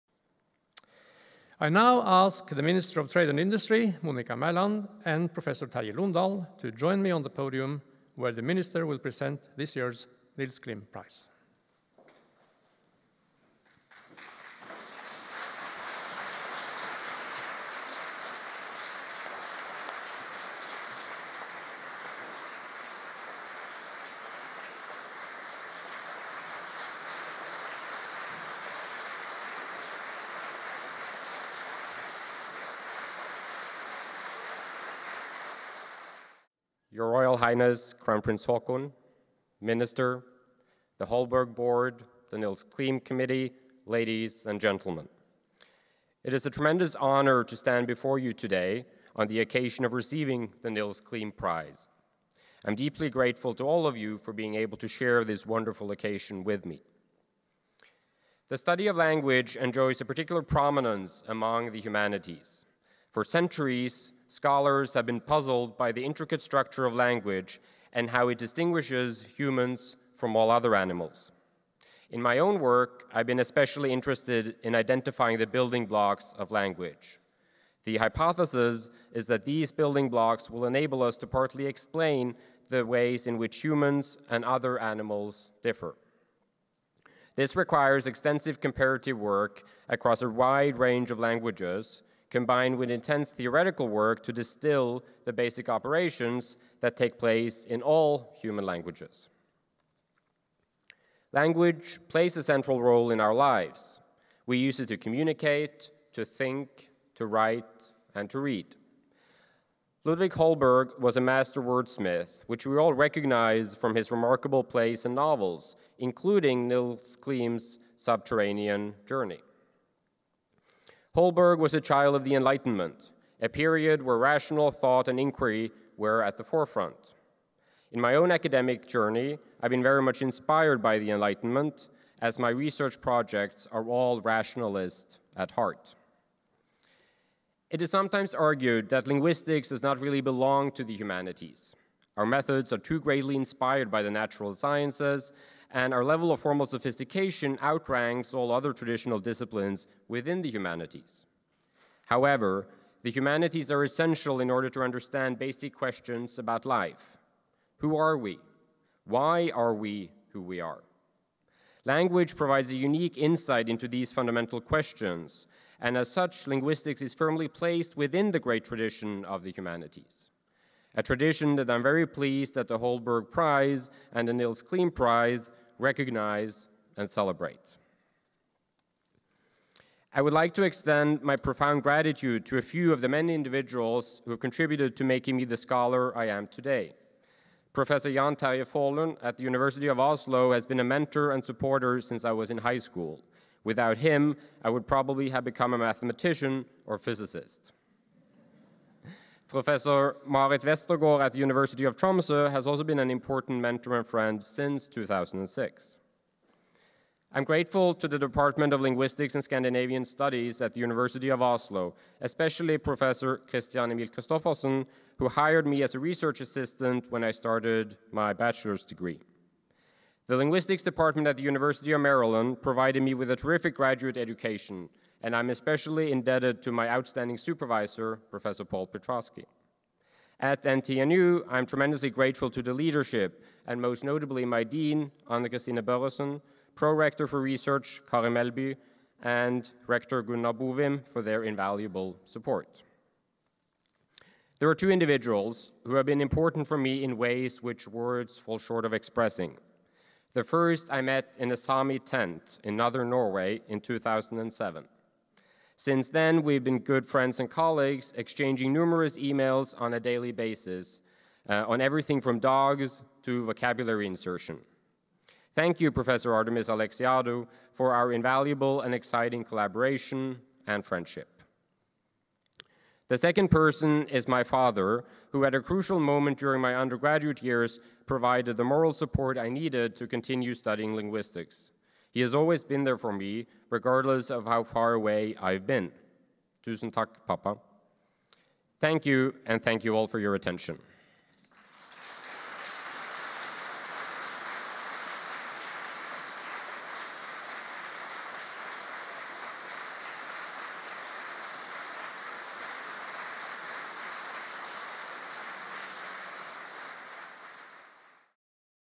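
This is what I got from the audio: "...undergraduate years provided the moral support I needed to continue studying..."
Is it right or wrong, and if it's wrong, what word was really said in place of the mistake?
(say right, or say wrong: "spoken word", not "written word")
right.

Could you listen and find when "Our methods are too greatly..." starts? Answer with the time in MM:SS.
02:22.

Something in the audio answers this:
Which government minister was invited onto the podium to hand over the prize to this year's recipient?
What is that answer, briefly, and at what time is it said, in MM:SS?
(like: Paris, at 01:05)
Monica Mæland, at 00:04.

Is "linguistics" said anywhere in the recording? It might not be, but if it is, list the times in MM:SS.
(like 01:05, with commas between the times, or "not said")
02:19, 02:46, 03:28, 03:40, 04:40.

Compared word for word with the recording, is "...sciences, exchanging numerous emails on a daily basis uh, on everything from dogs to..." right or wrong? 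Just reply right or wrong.
wrong.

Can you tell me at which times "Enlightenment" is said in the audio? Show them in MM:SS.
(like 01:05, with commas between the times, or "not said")
02:02, 02:11.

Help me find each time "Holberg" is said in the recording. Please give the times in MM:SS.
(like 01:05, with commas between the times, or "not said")
00:41, 01:50, 02:01, 02:52.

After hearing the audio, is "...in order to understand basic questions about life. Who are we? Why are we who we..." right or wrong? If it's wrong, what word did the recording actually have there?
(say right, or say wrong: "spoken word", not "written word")
right.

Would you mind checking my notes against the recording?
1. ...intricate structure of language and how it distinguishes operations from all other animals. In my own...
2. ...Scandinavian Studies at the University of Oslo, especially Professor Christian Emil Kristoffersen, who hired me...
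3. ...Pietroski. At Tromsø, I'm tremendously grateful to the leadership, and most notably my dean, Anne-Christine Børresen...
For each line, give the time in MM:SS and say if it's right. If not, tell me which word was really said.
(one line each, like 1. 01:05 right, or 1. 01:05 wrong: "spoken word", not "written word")
1. 01:06 wrong: "humans", not "operations"
2. 03:29 right
3. 03:48 wrong: "NTNU", not "Tromsø".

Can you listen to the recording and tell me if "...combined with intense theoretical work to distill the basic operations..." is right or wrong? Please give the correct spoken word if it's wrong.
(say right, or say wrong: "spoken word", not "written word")
right.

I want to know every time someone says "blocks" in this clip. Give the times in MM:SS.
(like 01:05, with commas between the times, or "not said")
01:15, 01:20.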